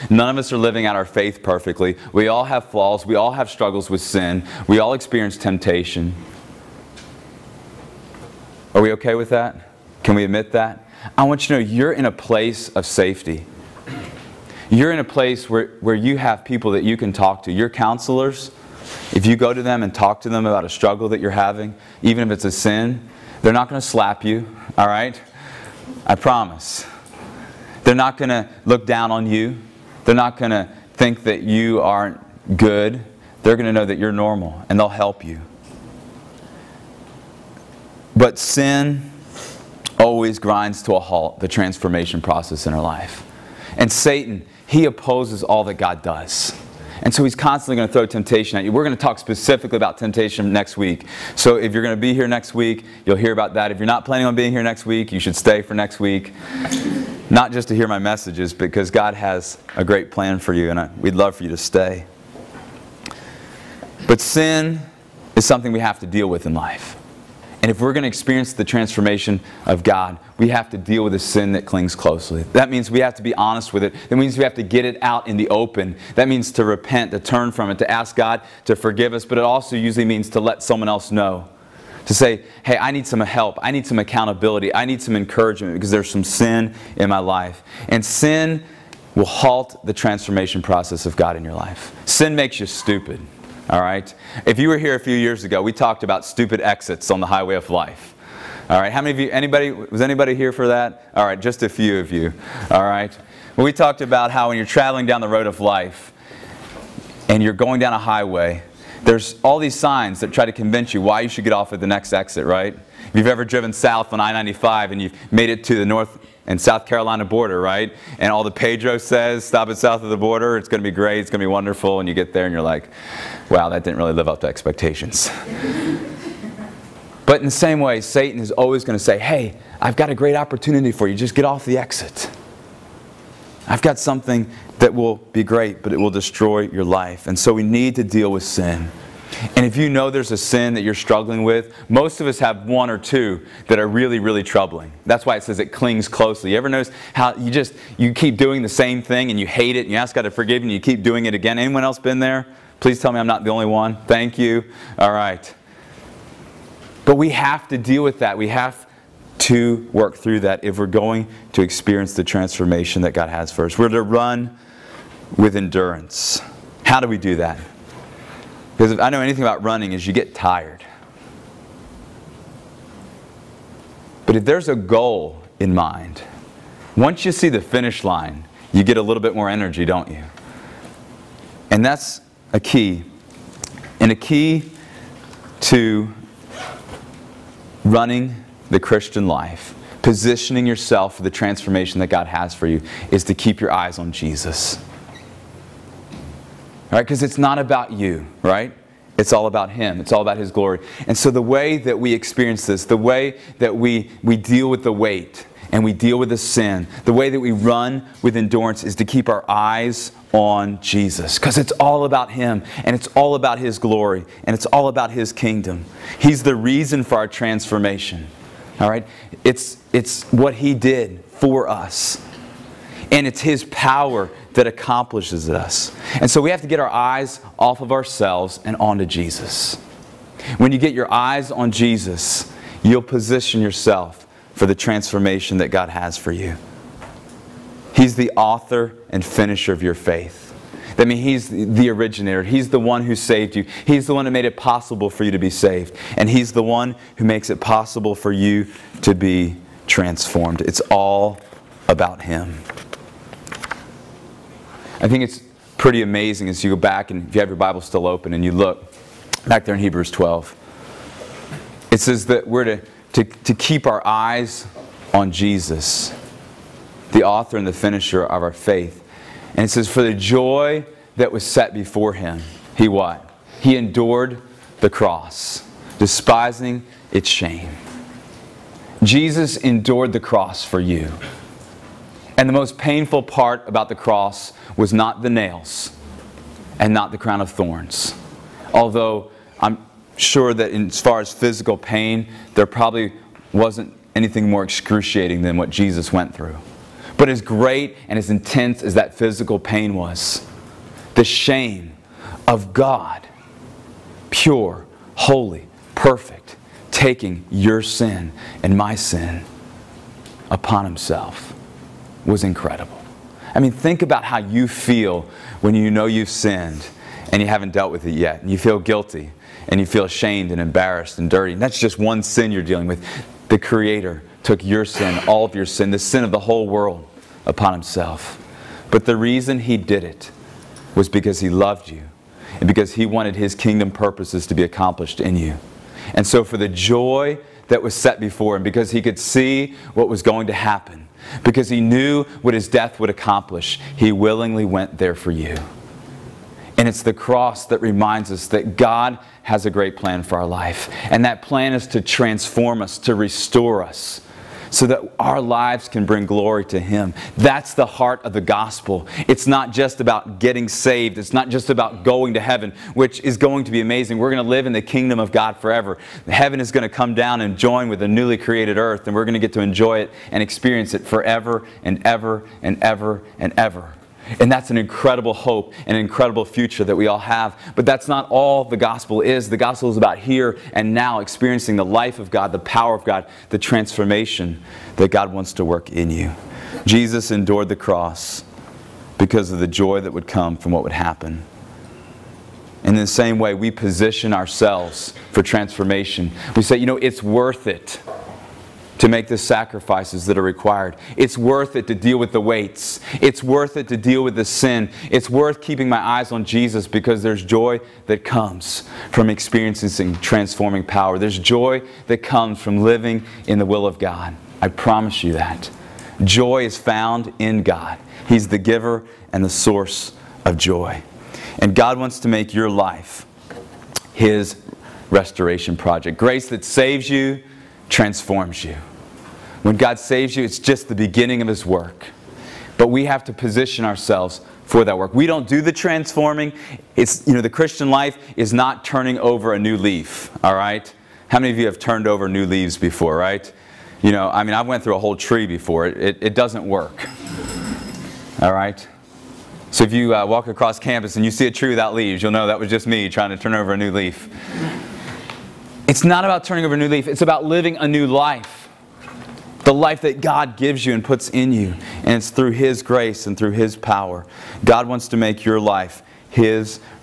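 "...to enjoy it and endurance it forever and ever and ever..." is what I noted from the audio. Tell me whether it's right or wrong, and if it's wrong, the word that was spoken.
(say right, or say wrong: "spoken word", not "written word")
wrong: "experience", not "endurance".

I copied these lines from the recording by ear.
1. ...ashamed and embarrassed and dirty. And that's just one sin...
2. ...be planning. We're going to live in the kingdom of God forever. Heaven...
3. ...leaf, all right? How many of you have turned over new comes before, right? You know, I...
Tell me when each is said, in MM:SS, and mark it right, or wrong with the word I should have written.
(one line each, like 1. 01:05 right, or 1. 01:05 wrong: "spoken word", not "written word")
1. 05:20 right
2. 06:03 wrong: "amazing", not "planning"
3. 07:19 wrong: "leaves", not "comes".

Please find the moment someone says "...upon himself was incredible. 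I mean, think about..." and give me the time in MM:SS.
05:10.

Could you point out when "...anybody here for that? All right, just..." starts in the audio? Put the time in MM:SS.
01:40.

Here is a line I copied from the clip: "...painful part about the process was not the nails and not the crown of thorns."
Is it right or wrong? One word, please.
wrong.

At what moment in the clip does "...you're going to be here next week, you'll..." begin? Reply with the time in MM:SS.
00:51.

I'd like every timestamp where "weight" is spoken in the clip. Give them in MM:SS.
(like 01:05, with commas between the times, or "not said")
03:24, 06:42.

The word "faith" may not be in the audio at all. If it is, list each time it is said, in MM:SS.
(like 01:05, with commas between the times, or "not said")
00:01, 03:59, 04:28.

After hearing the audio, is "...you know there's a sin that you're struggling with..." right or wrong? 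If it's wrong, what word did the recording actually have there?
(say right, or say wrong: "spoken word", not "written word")
right.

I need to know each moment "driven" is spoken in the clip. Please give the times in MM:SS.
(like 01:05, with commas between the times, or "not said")
01:53.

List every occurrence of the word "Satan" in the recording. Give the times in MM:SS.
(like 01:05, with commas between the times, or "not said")
00:43, 02:08.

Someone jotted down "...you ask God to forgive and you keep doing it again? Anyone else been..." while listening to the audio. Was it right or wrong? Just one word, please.
right.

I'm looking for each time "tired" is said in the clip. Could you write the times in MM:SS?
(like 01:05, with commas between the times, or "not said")
02:50.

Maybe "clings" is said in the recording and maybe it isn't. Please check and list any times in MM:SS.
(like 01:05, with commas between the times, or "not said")
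01:11, 02:25.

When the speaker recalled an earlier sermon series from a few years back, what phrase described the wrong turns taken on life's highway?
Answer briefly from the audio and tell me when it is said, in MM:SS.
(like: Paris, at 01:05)
stupid exits, at 01:36.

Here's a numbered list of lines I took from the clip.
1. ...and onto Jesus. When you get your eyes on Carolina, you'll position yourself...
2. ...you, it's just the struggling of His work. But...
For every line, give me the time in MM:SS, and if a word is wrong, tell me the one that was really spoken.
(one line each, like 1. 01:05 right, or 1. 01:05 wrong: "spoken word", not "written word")
1. 03:48 wrong: "Jesus", not "Carolina"
2. 07:10 wrong: "beginning", not "struggling".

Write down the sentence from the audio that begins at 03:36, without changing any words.
He's the reason for our transformation.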